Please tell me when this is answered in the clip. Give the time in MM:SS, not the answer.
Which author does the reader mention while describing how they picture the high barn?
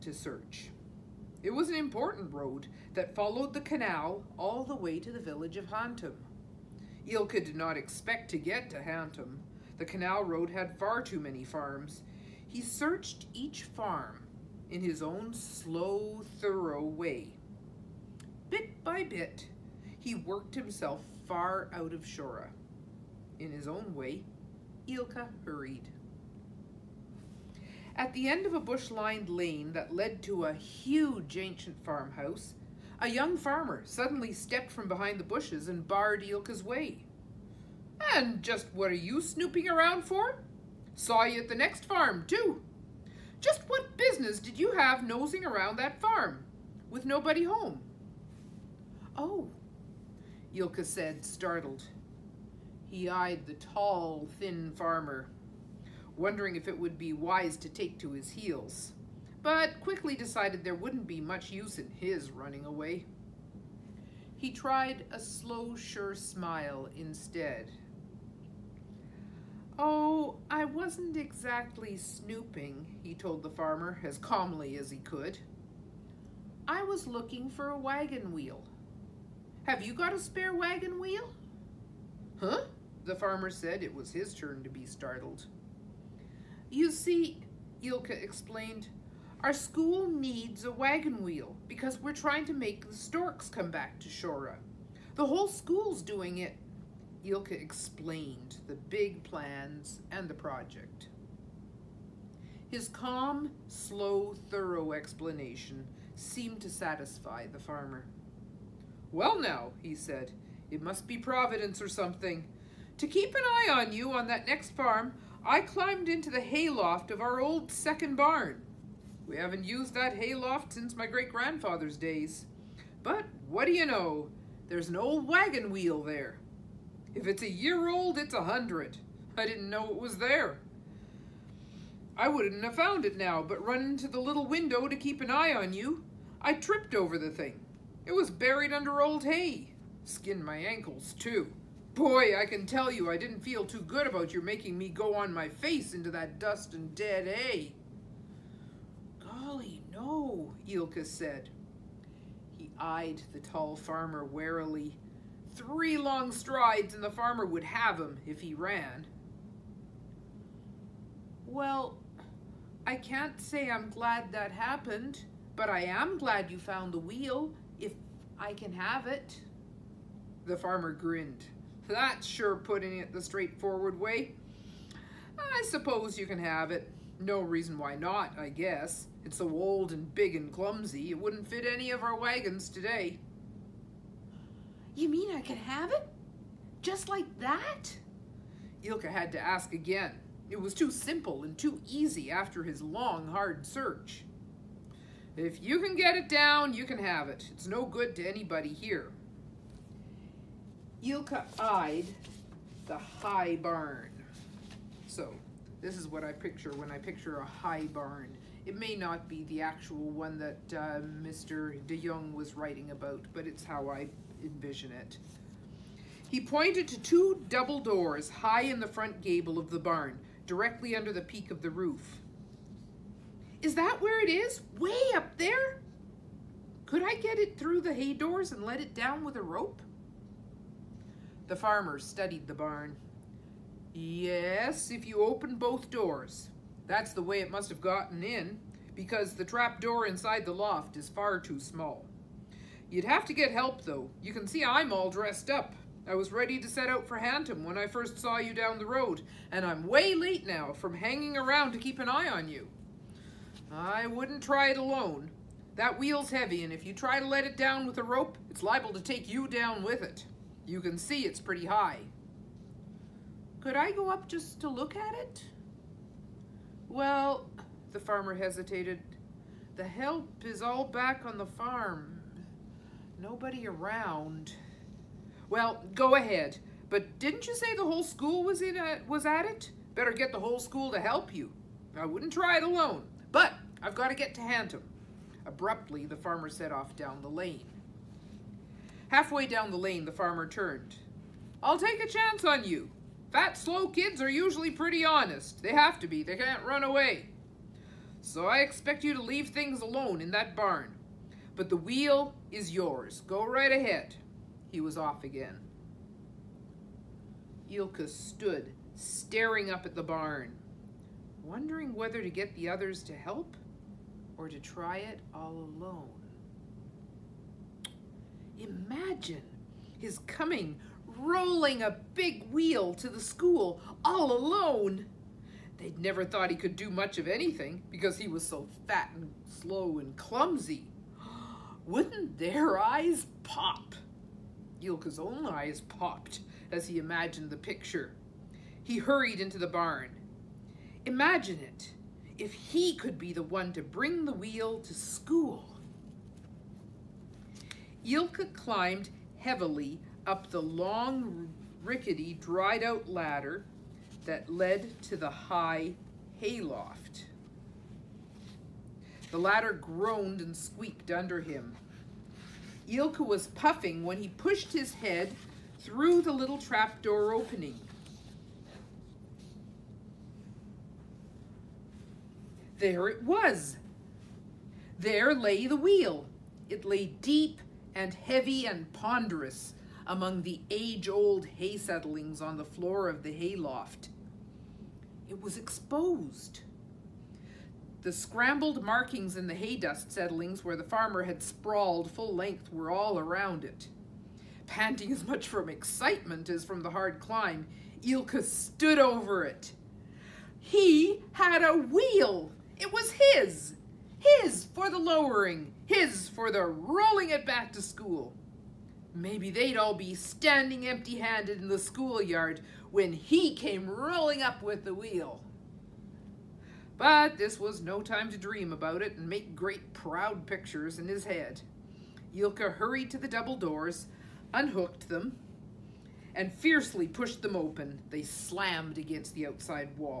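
03:31.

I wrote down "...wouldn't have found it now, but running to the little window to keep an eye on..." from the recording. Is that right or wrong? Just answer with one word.
right.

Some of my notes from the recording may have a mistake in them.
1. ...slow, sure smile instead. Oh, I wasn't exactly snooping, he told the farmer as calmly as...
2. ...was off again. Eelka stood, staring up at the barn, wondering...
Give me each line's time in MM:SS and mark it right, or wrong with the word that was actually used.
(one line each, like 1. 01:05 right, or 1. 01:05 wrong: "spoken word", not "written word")
1. 01:05 right
2. 05:04 right.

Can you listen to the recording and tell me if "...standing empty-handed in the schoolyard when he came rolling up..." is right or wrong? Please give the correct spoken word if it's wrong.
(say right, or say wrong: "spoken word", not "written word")
right.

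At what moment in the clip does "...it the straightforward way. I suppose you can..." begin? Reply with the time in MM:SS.
02:52.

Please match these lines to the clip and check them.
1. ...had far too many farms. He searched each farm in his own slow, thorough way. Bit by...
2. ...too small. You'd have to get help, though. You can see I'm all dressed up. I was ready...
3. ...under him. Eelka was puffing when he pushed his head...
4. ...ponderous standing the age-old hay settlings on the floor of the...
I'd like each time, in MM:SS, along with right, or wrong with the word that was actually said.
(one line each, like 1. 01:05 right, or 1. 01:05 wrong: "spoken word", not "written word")
1. 00:10 right
2. 04:01 right
3. 06:01 right
4. 06:18 wrong: "among", not "standing".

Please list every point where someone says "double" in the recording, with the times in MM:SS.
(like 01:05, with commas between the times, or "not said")
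03:37, 07:03.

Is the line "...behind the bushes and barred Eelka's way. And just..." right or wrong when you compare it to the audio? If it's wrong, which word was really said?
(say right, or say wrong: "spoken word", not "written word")
right.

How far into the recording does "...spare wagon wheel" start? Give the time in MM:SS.
01:20.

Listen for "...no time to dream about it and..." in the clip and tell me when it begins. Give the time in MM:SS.
06:57.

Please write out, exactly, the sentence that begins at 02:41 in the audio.
Well, I can't say I'm glad that happened, but I am glad you found the wheel, if I can have it.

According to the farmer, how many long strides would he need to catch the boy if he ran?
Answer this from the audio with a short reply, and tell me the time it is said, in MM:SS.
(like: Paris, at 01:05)
3, at 02:35.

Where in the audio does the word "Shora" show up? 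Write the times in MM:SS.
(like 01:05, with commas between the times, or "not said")
00:22, 01:34.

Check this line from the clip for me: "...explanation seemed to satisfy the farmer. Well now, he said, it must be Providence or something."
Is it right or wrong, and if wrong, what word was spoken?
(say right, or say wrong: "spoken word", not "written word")
right.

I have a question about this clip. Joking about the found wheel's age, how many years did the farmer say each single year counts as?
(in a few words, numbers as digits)
100.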